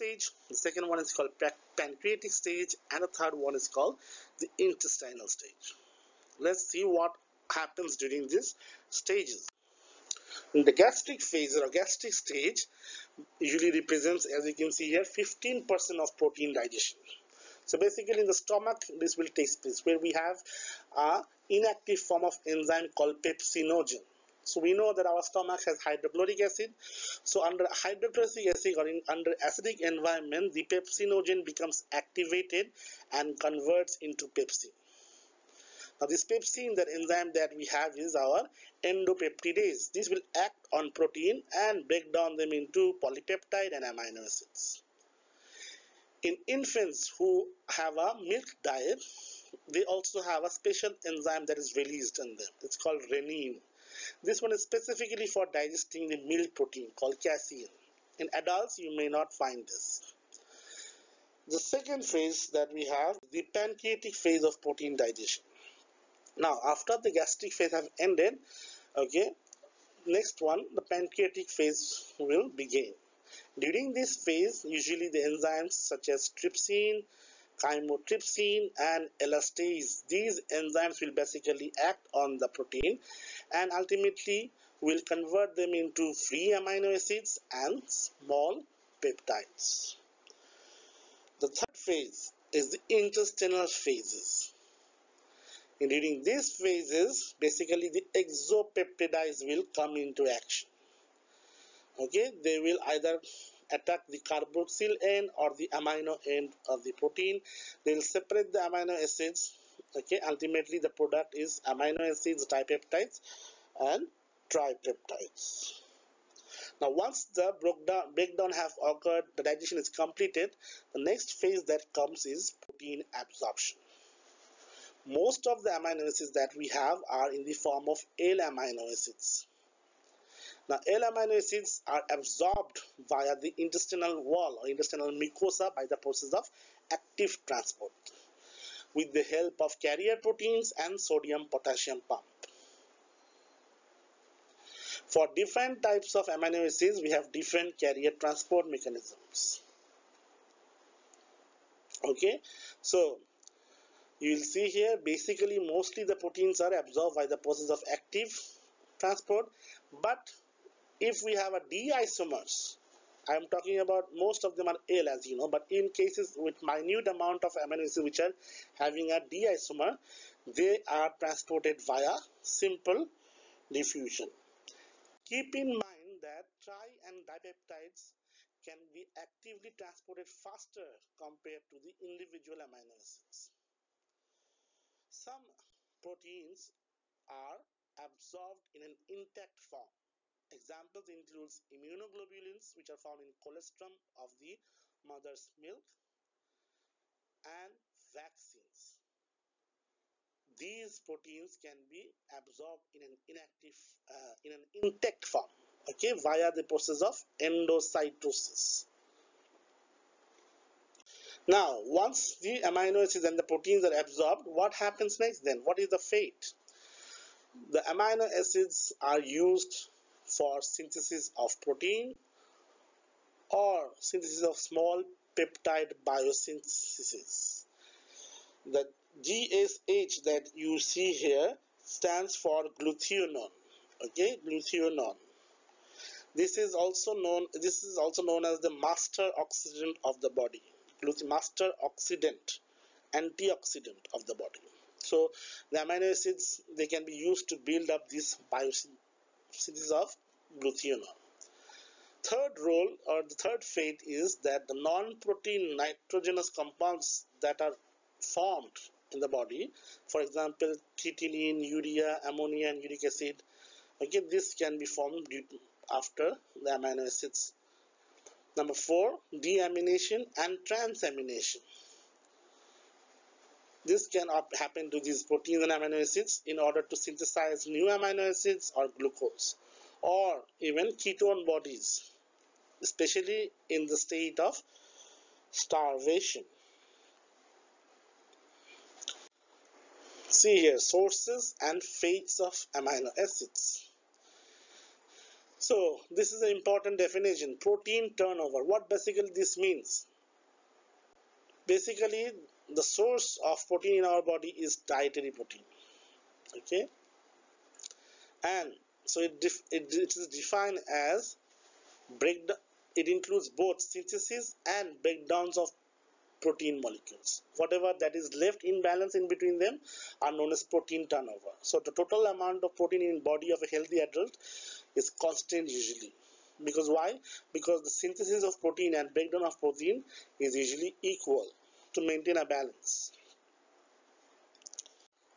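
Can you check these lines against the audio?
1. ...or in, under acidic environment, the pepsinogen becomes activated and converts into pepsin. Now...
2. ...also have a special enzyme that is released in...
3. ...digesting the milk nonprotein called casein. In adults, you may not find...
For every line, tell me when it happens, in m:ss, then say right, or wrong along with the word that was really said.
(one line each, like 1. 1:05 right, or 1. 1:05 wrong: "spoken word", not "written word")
1. 0:28 right
2. 0:49 right
3. 0:55 wrong: "protein", not "nonprotein".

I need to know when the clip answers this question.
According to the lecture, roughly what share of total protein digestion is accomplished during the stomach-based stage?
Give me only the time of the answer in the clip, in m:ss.
0:15.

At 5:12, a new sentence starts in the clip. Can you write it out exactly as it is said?
It includes both synthesis and breakdowns of protein molecules.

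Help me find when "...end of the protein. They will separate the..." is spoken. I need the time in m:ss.
1:46.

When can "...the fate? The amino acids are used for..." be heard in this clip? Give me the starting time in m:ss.
3:35.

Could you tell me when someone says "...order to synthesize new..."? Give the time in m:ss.
4:36.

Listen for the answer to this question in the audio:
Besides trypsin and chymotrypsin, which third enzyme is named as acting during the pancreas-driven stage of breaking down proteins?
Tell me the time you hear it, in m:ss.
1:19.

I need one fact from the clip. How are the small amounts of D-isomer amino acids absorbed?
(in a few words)
simple diffusion.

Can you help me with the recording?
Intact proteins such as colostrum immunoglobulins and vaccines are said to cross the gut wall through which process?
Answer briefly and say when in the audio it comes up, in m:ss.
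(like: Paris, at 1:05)
endocytosis, at 3:27.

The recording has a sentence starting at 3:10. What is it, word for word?
Examples include immunoglobulins which are found in colostrum of the mother's milk and vaccines.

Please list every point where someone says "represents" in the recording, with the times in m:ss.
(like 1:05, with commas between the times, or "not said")
0:13.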